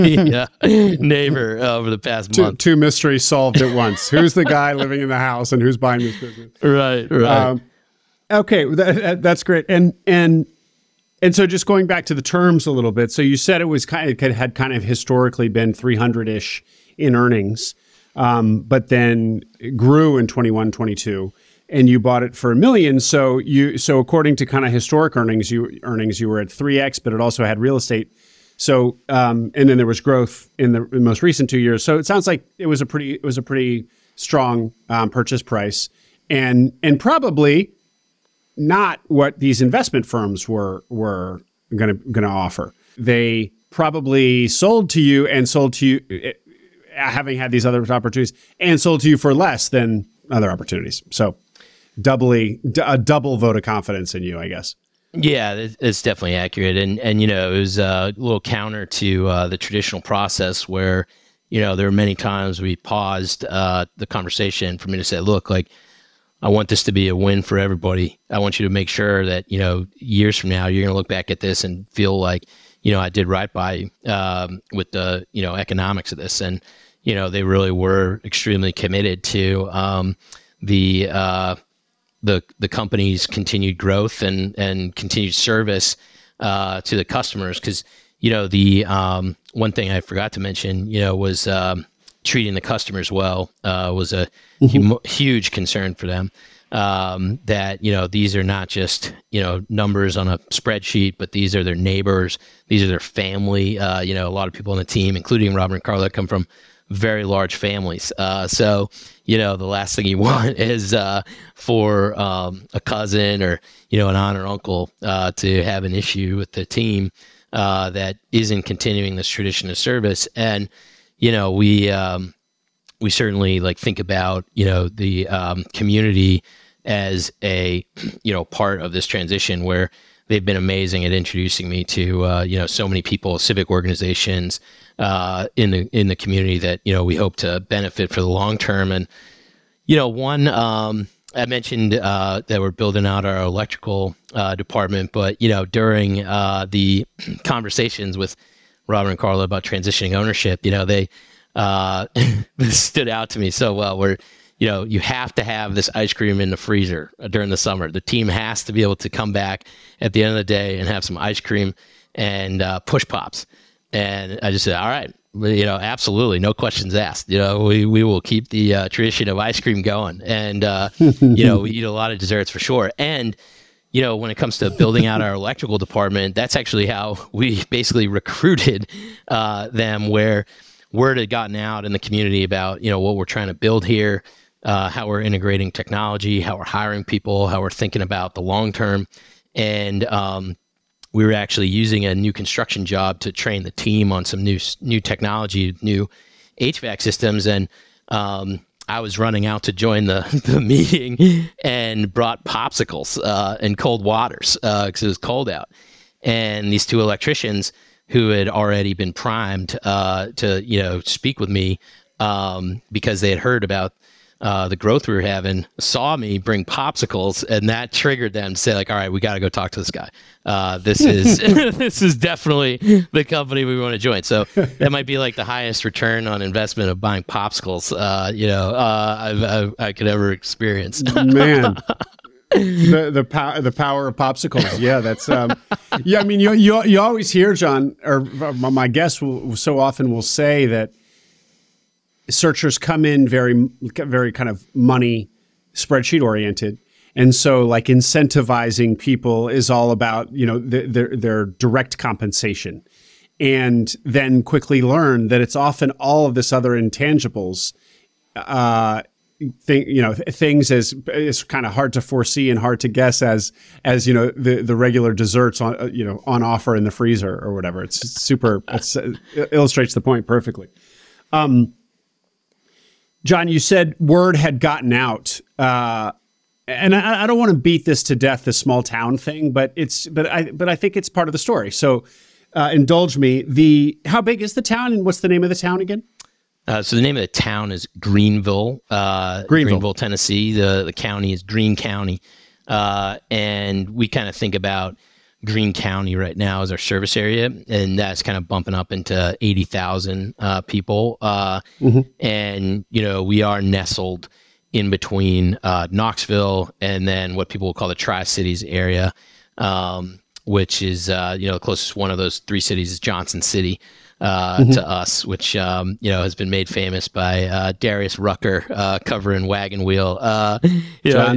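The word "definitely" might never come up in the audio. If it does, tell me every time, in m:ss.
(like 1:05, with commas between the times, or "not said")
0:56, 3:42.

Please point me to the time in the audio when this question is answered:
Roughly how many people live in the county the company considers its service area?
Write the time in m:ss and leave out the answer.
4:59.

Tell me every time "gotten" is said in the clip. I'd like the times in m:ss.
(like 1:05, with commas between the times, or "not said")
3:01, 4:34.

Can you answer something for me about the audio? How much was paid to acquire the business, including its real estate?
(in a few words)
1 million.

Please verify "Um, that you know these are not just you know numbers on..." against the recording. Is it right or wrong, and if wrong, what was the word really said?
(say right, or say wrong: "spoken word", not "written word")
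right.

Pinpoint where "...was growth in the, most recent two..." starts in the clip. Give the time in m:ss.
0:29.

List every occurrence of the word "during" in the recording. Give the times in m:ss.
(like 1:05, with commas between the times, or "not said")
2:25, 2:37.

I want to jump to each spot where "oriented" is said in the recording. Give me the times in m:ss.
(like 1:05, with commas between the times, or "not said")
4:06.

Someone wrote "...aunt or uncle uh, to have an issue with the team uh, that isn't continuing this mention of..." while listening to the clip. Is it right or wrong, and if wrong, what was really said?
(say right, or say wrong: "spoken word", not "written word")
wrong: "tradition", not "mention".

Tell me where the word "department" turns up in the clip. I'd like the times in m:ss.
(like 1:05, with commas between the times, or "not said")
2:24, 2:55.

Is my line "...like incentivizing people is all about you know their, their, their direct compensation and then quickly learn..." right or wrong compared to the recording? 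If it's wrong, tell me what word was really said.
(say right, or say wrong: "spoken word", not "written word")
right.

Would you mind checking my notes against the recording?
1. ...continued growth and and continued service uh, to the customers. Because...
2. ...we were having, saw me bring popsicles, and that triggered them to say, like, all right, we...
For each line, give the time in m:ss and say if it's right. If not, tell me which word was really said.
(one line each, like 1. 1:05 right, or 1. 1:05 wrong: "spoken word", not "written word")
1. 1:23 right
2. 3:35 right.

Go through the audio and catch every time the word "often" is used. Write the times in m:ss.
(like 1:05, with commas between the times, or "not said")
3:59, 4:15.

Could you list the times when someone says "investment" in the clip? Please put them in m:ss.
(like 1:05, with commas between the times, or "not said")
0:39, 3:46.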